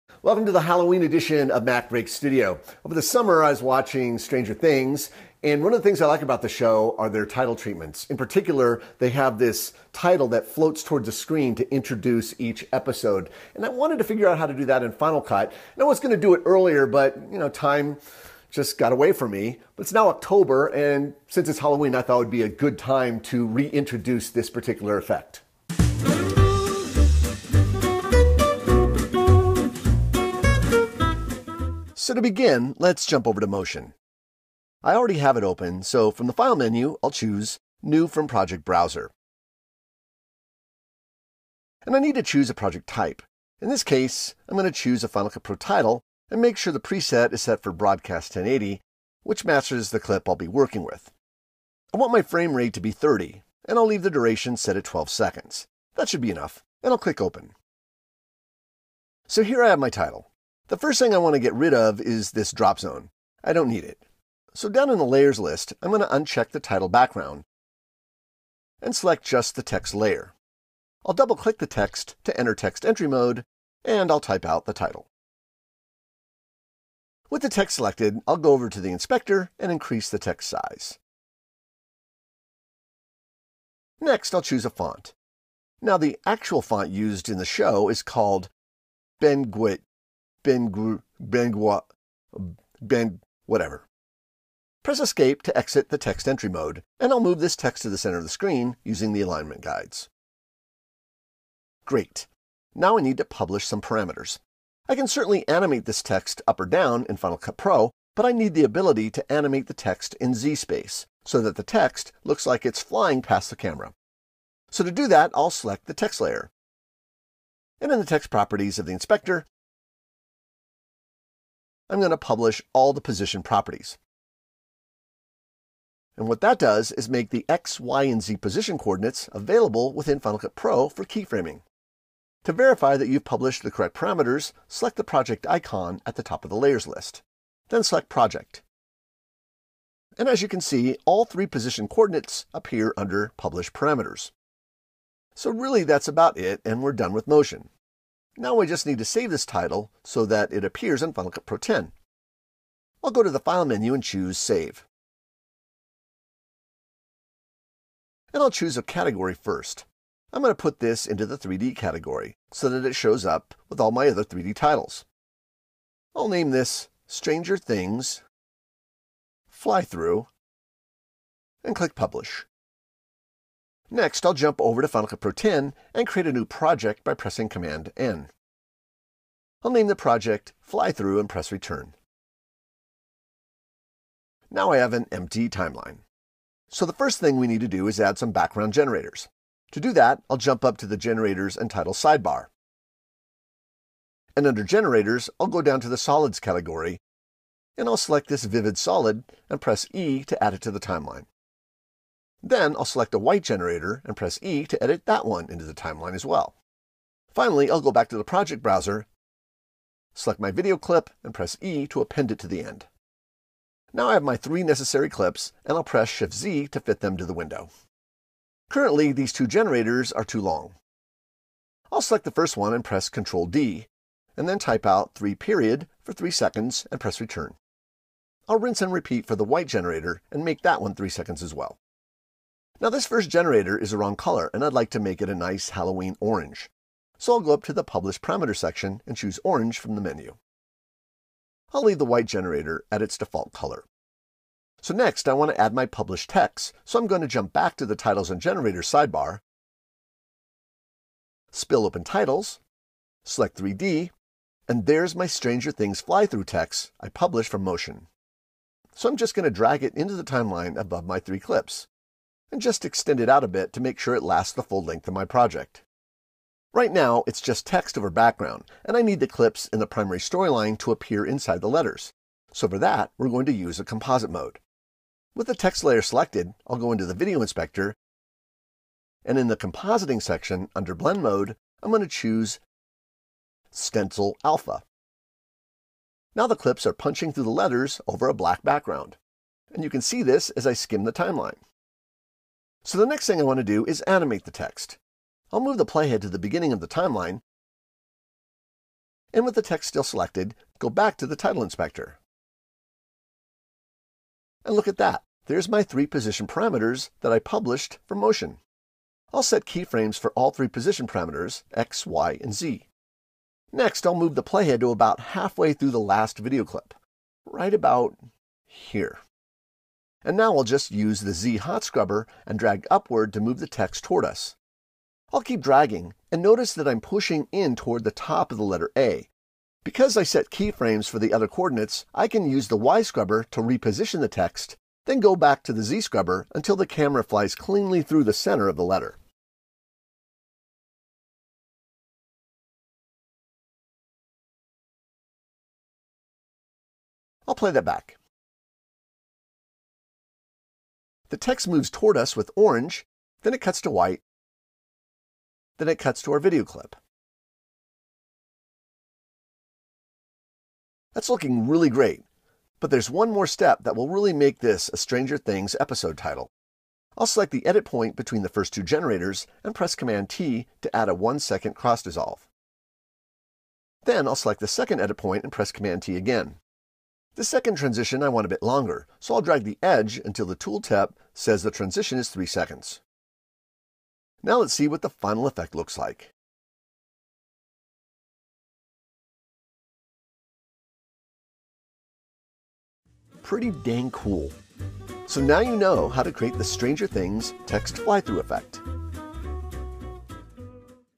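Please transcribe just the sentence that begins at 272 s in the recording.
So for that, we're going to use a composite mode.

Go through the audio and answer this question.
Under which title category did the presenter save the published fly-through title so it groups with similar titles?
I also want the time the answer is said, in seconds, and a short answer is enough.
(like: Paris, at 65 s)
3D, at 161 s.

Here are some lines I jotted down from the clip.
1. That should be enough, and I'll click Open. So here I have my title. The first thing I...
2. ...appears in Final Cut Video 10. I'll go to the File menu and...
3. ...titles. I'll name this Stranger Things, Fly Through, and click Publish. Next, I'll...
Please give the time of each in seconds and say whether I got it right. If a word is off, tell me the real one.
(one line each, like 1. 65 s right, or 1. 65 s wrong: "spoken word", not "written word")
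1. 55 s right
2. 150 s wrong: "Pro", not "Video"
3. 164 s right.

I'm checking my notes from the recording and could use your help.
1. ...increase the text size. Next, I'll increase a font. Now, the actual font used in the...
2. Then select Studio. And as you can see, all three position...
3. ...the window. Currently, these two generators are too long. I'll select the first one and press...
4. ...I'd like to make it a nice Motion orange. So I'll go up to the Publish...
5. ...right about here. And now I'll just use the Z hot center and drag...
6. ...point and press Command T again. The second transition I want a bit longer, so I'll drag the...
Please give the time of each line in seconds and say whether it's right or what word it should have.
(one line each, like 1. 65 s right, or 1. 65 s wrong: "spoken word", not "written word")
1. 79 s wrong: "choose", not "increase"
2. 137 s wrong: "Project", not "Studio"
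3. 217 s right
4. 234 s wrong: "Halloween", not "Motion"
5. 317 s wrong: "scrubber", not "center"
6. 375 s right.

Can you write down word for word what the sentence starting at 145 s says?
So really that's about it and we're done with motion.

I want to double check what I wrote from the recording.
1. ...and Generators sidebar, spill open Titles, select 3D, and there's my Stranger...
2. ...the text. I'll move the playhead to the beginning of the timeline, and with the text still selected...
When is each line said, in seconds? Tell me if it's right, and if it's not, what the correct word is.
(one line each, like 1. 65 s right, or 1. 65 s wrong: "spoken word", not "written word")
1. 248 s right
2. 294 s right.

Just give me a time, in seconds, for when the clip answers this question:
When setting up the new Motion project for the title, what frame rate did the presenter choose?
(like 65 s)
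52 s.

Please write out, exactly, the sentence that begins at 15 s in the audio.
And I was going to do it earlier, but you know, time just got away from me.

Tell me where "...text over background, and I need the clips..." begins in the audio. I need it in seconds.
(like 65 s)
267 s.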